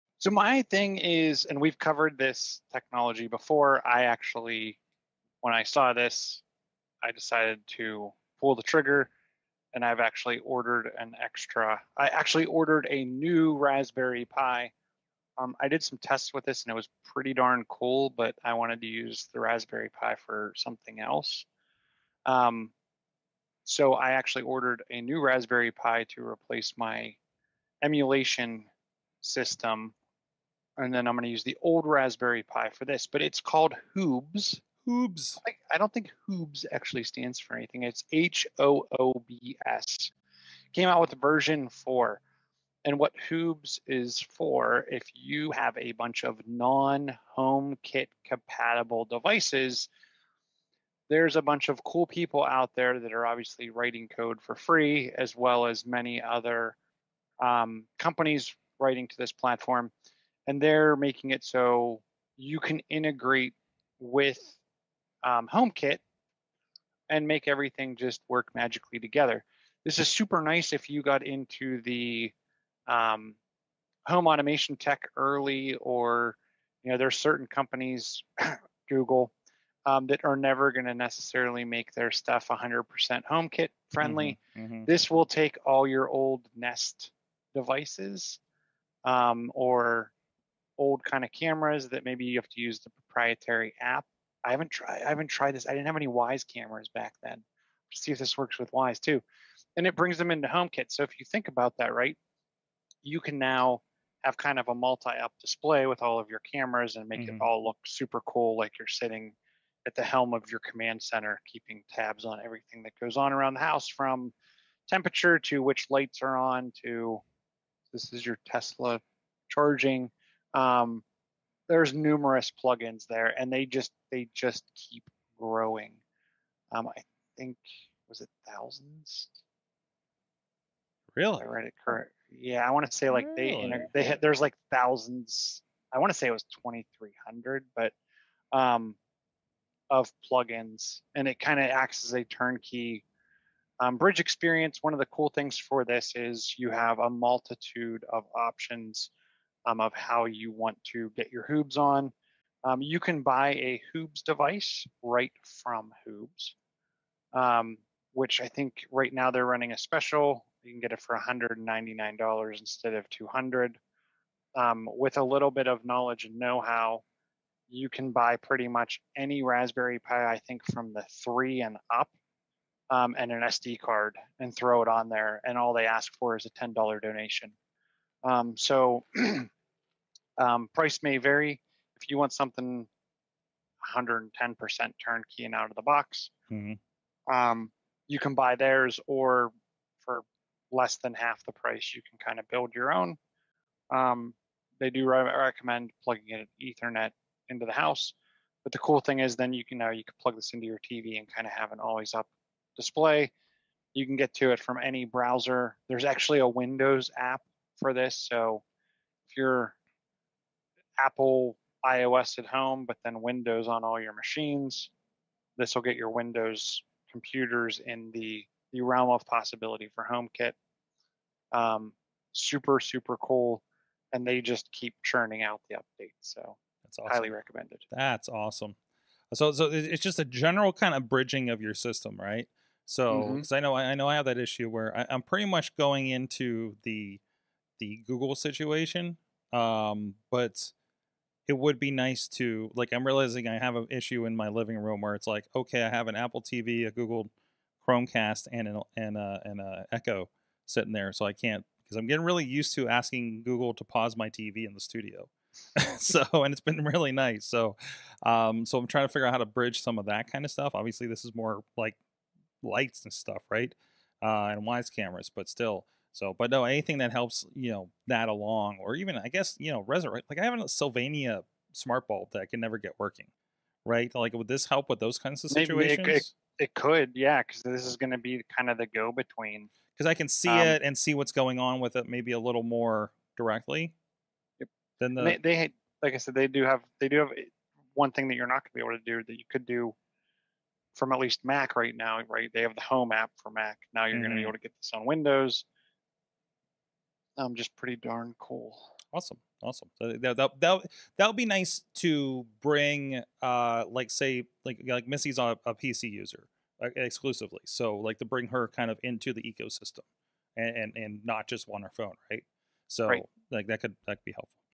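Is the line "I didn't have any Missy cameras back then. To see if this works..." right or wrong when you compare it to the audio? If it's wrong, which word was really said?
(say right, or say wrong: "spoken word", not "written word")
wrong: "Wyze", not "Missy".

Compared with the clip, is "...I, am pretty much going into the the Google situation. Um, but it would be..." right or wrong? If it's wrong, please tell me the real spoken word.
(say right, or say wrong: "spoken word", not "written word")
right.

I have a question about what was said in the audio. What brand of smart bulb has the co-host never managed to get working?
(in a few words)
Sylvania.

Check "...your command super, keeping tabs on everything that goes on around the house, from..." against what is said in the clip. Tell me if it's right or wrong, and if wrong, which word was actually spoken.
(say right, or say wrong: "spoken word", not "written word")
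wrong: "center", not "super".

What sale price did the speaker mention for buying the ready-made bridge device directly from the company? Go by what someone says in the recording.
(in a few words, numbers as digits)
$199.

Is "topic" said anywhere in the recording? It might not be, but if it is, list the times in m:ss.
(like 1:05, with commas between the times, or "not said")
not said.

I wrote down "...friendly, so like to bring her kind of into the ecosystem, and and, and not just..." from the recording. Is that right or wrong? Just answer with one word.
wrong.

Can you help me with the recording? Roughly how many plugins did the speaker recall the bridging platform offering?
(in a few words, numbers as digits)
2,300.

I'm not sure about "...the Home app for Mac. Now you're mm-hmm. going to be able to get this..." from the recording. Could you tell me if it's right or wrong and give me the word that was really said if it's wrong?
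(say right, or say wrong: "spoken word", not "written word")
right.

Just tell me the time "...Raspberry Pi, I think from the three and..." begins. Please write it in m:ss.
2:49.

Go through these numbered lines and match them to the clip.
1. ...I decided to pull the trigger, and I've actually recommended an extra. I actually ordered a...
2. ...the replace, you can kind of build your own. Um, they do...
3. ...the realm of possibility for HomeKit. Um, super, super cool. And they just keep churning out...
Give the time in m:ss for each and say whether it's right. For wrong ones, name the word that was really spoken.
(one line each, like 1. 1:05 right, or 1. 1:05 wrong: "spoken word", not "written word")
1. 0:07 wrong: "ordered", not "recommended"
2. 3:11 wrong: "price", not "replace"
3. 3:38 right.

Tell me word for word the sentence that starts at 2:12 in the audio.
Yeah, I want to say like really?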